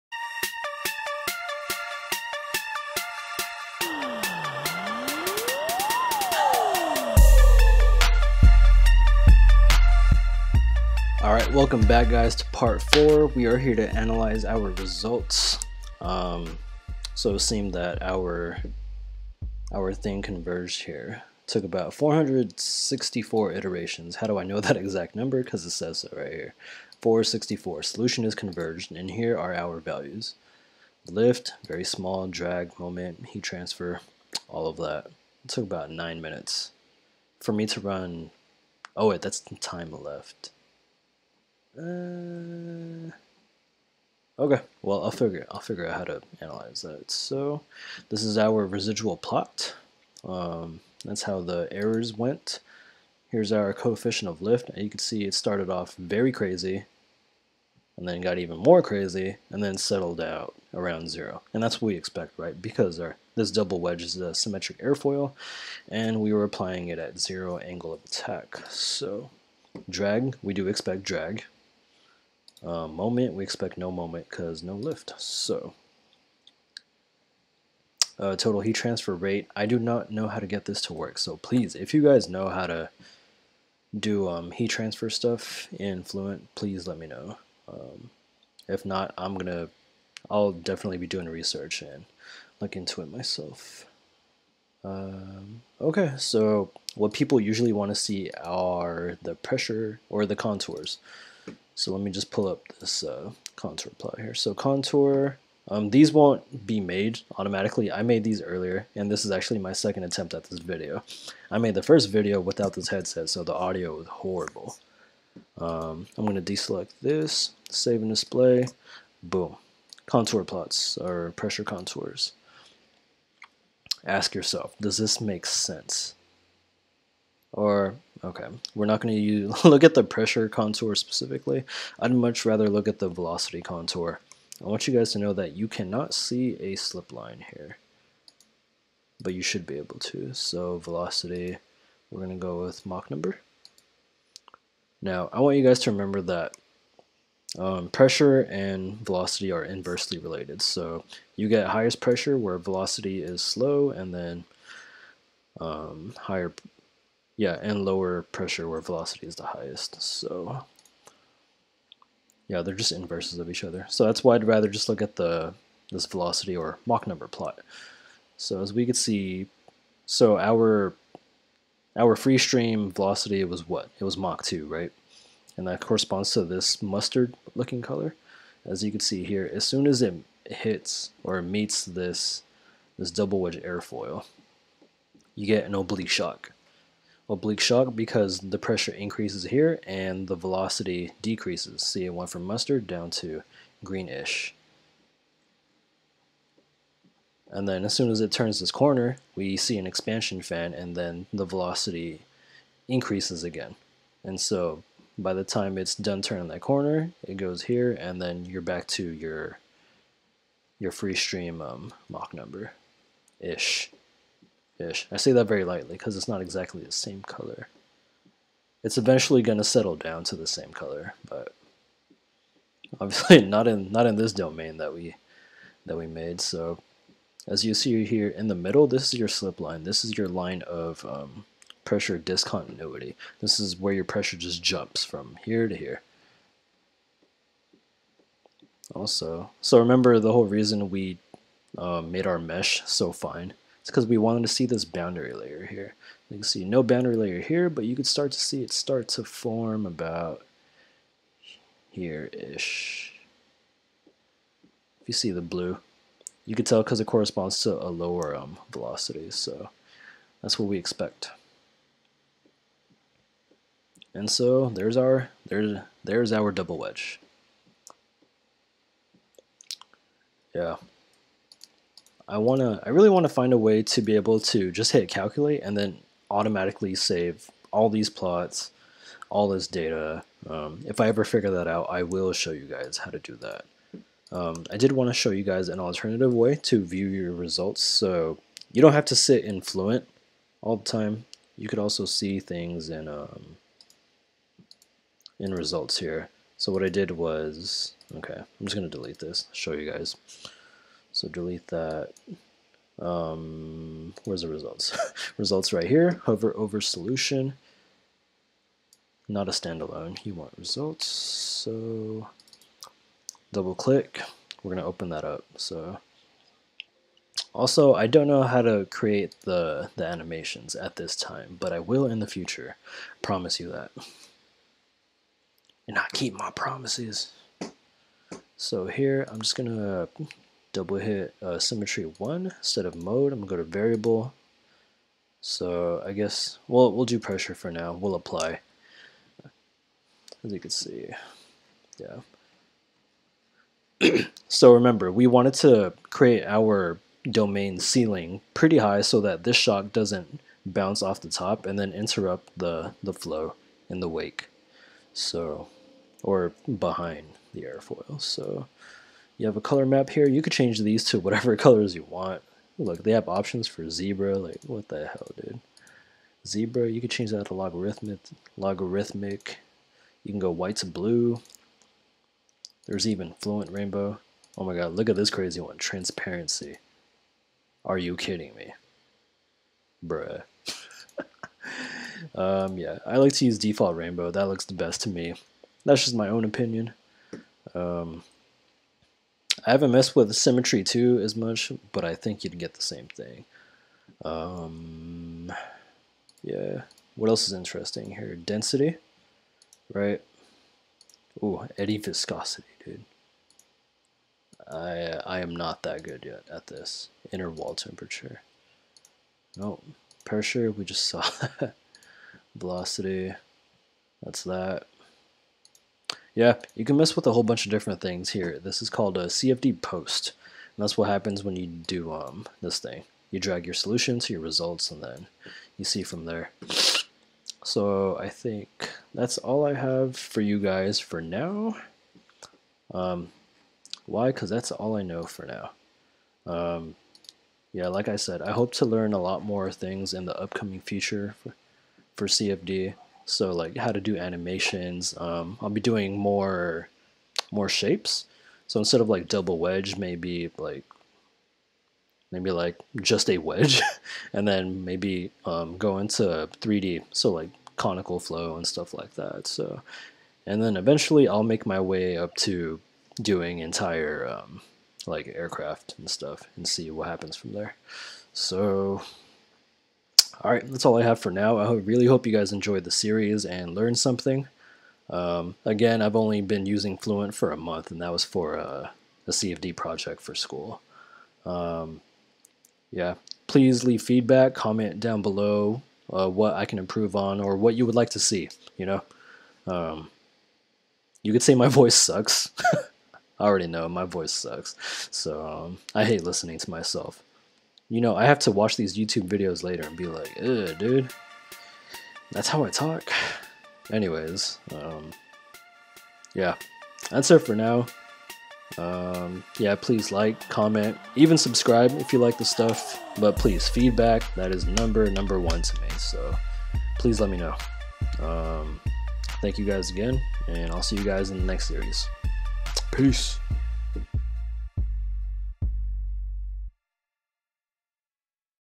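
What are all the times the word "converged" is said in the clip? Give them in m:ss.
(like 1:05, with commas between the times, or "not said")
0:20, 0:28.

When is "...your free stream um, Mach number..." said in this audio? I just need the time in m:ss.
3:30.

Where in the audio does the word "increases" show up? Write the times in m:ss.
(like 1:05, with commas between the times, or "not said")
3:08, 3:22.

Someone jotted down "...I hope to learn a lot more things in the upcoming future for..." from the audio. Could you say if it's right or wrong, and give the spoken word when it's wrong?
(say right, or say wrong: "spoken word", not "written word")
right.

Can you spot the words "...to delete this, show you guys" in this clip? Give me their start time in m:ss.
4:58.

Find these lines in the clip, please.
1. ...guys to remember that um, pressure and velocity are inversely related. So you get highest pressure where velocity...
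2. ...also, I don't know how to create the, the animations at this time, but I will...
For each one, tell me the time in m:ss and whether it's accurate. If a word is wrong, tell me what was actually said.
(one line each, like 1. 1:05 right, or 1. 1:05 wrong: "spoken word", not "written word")
1. 2:25 right
2. 5:17 right.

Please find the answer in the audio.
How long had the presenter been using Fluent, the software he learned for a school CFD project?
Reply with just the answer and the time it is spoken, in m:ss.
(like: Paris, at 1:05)
a month, at 7:57.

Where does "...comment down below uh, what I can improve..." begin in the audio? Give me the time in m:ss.
8:04.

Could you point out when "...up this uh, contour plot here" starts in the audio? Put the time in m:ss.
1:42.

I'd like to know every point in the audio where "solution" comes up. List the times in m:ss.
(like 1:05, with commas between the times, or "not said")
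0:27, 5:06, 7:03.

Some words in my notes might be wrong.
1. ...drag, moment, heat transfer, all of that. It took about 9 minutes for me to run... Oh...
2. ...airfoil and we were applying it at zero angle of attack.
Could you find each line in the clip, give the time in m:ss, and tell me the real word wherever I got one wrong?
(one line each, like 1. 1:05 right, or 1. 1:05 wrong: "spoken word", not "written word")
1. 0:32 right
2. 1:04 right.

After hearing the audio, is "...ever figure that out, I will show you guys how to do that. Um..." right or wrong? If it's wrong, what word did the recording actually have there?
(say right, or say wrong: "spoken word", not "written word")
right.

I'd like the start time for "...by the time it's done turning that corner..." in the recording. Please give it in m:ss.
3:25.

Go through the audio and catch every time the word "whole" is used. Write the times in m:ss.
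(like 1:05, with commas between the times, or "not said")
4:00, 6:57.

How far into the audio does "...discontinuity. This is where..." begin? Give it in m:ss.
3:52.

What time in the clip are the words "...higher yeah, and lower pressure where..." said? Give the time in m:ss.
2:36.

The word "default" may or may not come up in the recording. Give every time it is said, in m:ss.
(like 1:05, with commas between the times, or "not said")
6:23.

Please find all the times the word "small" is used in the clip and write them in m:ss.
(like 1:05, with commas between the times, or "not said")
0:31.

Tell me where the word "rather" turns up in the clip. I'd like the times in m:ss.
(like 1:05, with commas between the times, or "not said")
2:12, 2:44.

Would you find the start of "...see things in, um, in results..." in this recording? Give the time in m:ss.
4:52.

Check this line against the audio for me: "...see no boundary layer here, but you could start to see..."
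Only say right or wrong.
right.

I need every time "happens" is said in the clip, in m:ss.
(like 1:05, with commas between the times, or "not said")
7:01, 7:47.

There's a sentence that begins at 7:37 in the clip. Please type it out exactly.
So like conical flow and stuff like that.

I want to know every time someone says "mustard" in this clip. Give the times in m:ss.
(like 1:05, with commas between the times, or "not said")
2:56, 3:12.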